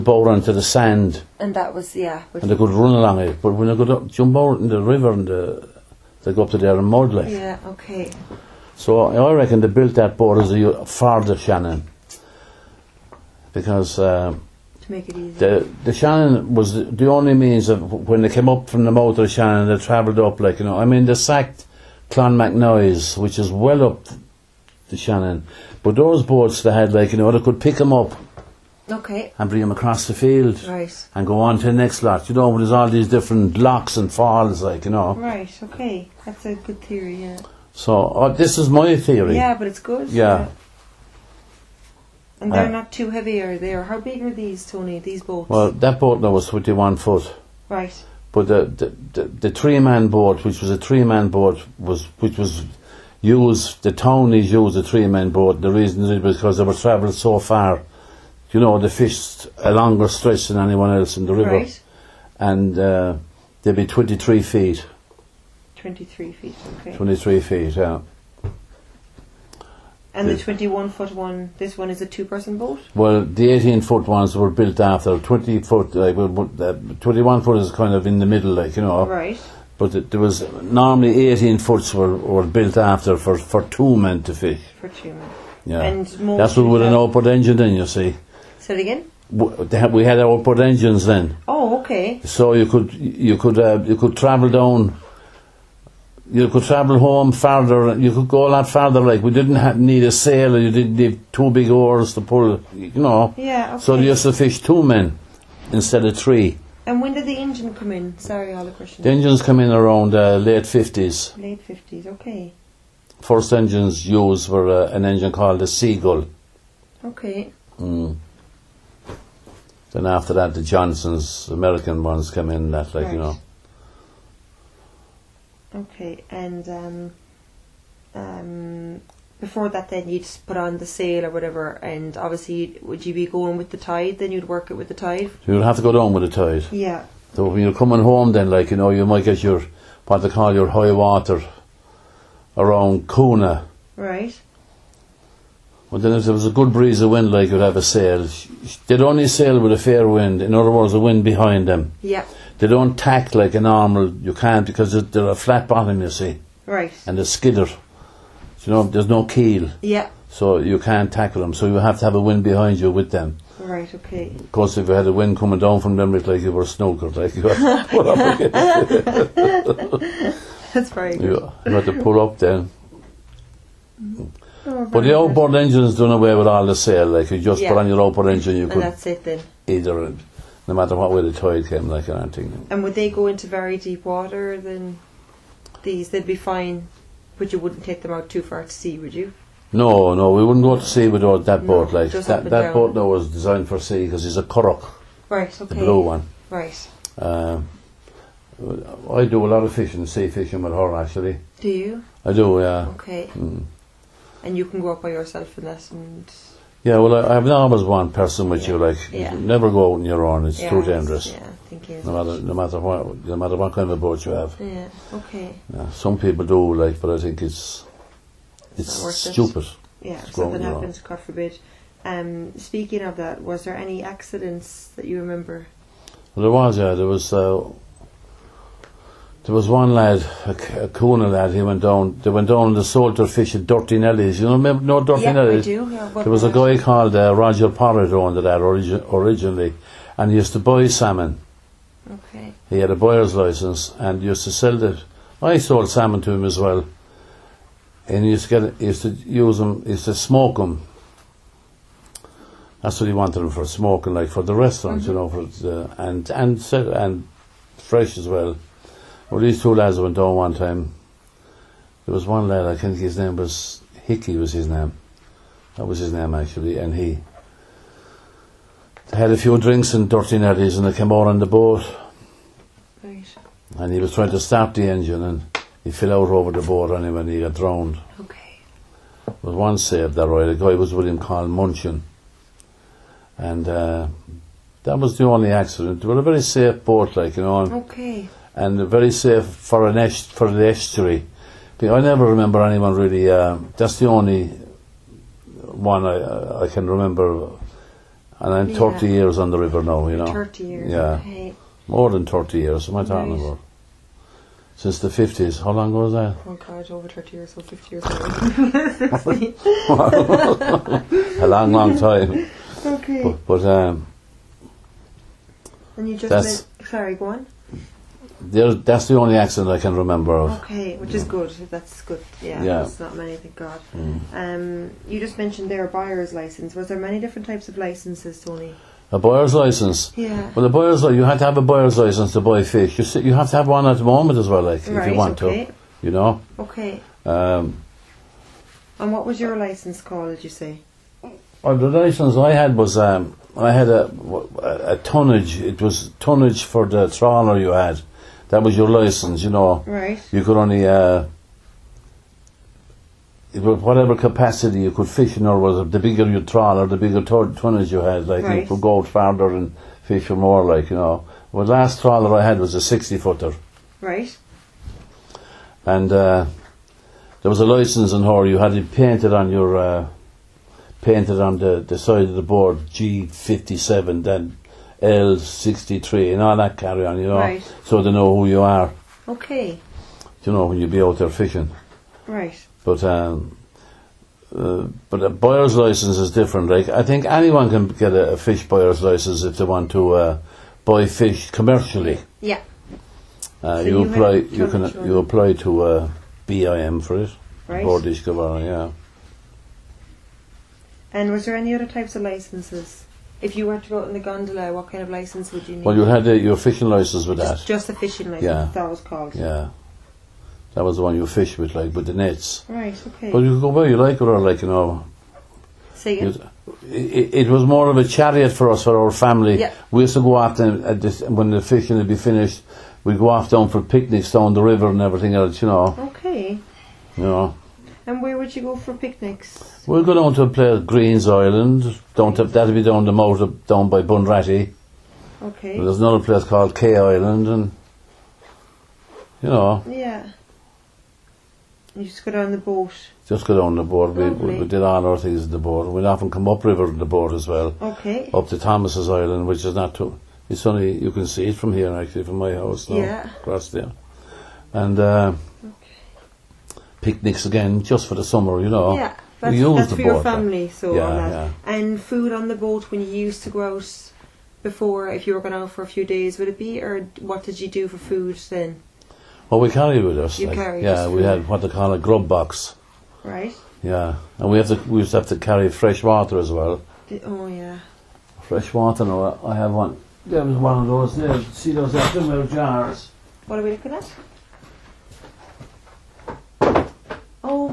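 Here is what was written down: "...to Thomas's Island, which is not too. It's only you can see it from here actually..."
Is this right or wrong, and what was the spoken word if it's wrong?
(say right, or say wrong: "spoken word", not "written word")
right.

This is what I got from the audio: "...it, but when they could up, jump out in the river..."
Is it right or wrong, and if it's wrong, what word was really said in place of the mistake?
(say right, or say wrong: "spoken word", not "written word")
right.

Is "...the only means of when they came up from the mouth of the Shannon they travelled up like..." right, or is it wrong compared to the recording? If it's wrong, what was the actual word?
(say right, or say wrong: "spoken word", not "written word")
right.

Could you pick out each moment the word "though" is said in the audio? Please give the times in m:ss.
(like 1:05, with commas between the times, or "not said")
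3:12.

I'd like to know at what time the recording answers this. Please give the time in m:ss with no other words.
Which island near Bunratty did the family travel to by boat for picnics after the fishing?
7:10.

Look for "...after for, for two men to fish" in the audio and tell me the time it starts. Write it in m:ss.
1:22.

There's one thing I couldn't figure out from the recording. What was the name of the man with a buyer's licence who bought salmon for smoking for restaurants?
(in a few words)
Roger Potter.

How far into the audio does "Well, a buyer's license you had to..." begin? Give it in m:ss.
5:30.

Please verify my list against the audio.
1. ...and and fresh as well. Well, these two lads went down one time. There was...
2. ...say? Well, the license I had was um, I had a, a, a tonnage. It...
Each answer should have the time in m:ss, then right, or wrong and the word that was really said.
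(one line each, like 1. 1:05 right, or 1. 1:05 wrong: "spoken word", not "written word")
1. 4:16 right
2. 5:40 right.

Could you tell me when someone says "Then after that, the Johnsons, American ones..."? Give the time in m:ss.
1:59.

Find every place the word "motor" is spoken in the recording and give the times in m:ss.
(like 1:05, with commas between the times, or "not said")
7:13.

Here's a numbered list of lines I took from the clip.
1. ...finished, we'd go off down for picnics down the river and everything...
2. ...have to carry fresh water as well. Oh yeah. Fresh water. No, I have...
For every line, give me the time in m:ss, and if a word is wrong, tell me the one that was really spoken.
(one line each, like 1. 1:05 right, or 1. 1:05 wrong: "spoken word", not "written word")
1. 7:02 right
2. 7:55 right.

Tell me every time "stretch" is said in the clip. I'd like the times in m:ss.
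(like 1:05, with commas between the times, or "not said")
1:00.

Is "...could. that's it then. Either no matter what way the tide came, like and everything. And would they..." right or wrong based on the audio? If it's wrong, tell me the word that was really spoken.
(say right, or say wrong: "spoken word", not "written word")
right.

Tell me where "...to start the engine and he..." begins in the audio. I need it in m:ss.
4:34.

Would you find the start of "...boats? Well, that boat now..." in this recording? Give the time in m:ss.
0:45.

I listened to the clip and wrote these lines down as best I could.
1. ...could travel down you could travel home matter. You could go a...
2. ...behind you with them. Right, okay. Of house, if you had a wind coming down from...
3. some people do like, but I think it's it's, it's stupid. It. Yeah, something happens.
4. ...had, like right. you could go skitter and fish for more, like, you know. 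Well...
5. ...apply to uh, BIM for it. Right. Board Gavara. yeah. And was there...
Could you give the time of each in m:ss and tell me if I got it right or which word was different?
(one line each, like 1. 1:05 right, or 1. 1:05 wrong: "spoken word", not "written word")
1. 1:33 wrong: "farther", not "matter"
2. 2:42 wrong: "course", not "house"
3. 3:35 right
4. 5:57 wrong: "farther", not "skitter"
5. 6:35 right.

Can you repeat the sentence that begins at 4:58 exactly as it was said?
30 years on the river now.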